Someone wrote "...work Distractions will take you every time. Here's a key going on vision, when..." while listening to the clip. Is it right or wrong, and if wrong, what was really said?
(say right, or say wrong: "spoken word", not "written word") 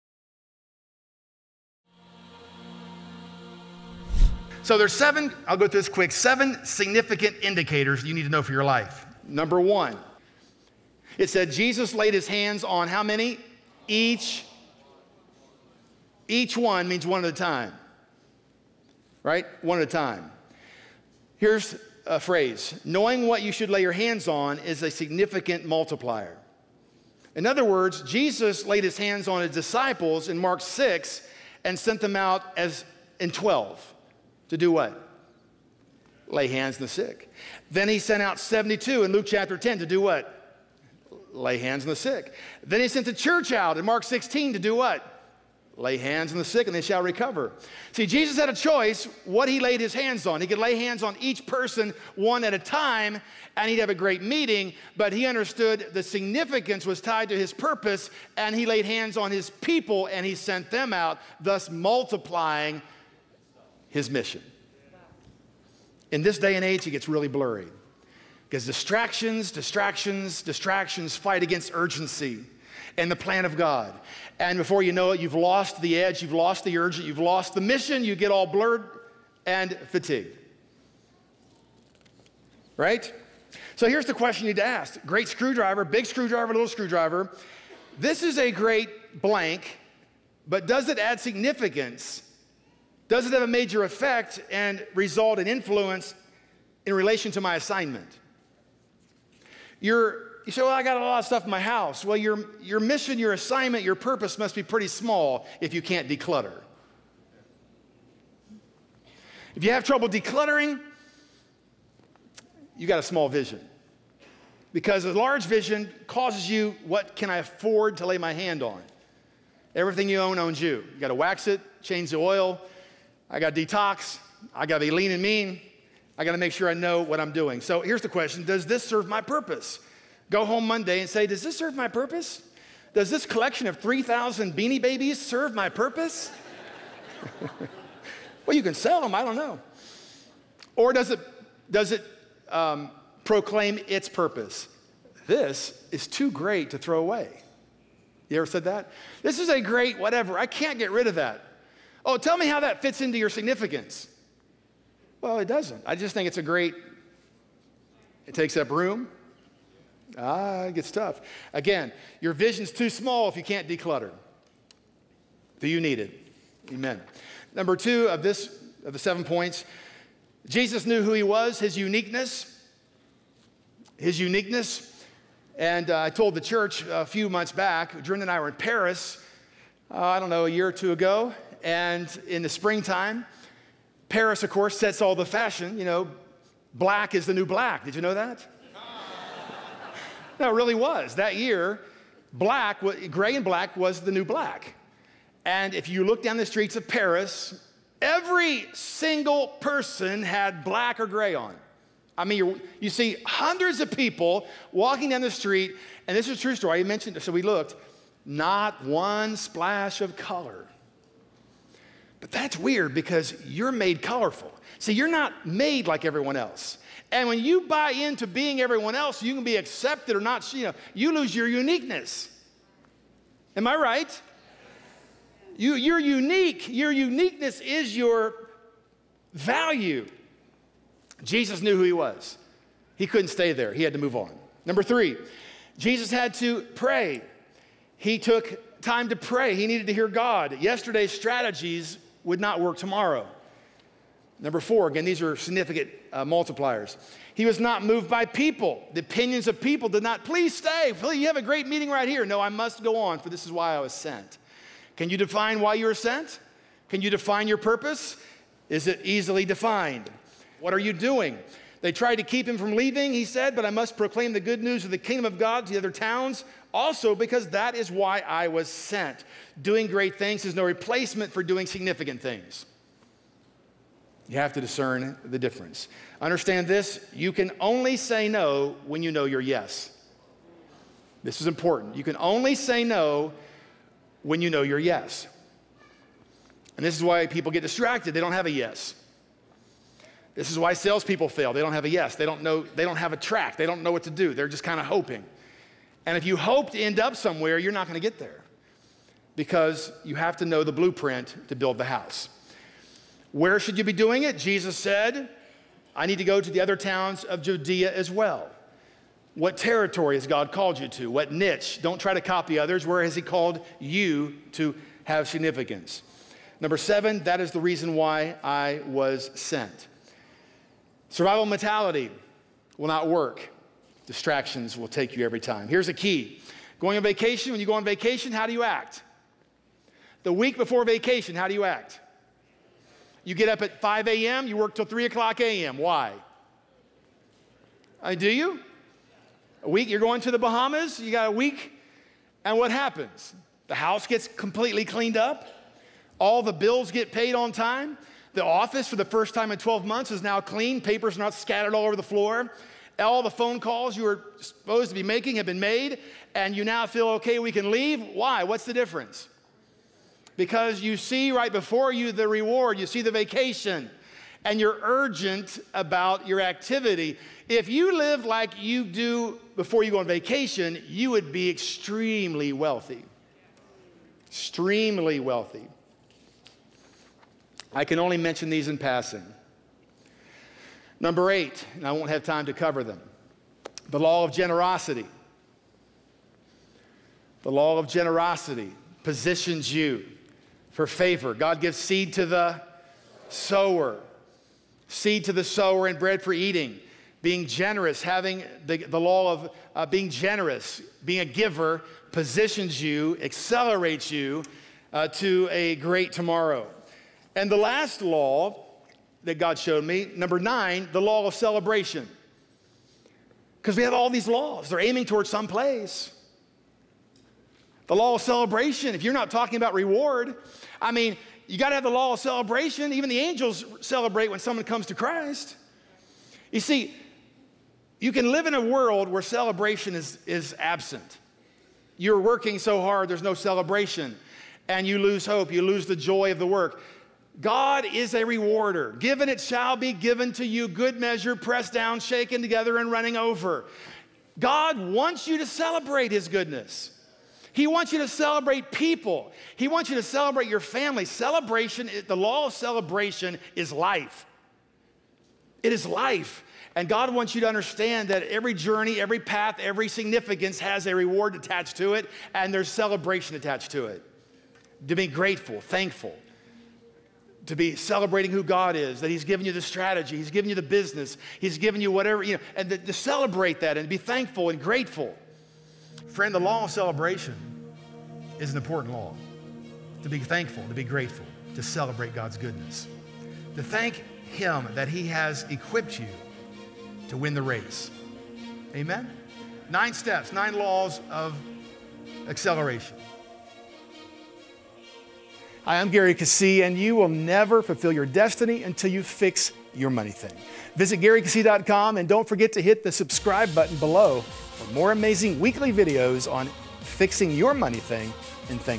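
wrong: "vacation", not "vision".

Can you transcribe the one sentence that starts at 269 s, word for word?
Doing great things is no replacement for doing significant things.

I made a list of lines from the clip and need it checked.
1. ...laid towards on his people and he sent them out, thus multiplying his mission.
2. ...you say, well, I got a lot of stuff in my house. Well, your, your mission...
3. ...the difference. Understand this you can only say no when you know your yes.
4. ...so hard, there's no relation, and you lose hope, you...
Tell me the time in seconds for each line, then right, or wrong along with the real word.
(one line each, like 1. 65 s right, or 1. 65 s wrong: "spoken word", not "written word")
1. 58 s wrong: "hands", not "towards"
2. 100 s right
3. 275 s right
4. 432 s wrong: "celebration", not "relation".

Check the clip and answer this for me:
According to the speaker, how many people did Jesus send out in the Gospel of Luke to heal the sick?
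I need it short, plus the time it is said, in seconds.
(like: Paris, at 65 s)
72, at 38 s.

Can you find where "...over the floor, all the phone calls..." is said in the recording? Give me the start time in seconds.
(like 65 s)
351 s.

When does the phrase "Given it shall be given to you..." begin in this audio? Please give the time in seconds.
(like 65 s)
438 s.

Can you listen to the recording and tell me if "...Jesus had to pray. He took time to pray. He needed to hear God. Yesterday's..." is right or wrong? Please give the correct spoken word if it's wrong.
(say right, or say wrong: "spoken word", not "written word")
right.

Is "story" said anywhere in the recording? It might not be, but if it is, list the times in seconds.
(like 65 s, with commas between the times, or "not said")
206 s.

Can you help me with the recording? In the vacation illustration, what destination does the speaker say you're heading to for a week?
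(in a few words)
the Bahamas.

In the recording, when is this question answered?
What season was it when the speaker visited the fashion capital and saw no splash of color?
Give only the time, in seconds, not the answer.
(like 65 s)
182 s.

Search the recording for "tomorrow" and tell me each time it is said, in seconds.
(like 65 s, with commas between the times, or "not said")
242 s, 406 s.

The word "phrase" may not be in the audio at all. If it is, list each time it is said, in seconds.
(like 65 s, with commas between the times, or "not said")
22 s.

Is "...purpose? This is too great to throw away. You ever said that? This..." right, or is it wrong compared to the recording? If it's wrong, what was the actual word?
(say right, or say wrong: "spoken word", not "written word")
right.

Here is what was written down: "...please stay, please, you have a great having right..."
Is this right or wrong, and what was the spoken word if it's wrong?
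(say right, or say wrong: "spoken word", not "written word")
wrong: "meeting", not "having".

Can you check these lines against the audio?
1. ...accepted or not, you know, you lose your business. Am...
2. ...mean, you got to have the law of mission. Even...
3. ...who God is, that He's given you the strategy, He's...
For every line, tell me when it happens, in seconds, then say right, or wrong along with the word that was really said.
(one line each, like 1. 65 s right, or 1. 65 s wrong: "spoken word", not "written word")
1. 219 s wrong: "uniqueness", not "business"
2. 420 s wrong: "celebration", not "mission"
3. 468 s right.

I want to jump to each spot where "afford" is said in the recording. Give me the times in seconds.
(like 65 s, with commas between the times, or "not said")
117 s.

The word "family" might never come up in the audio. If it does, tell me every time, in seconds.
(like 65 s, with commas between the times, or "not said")
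450 s.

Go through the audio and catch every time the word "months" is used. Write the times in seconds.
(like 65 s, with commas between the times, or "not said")
177 s, 349 s.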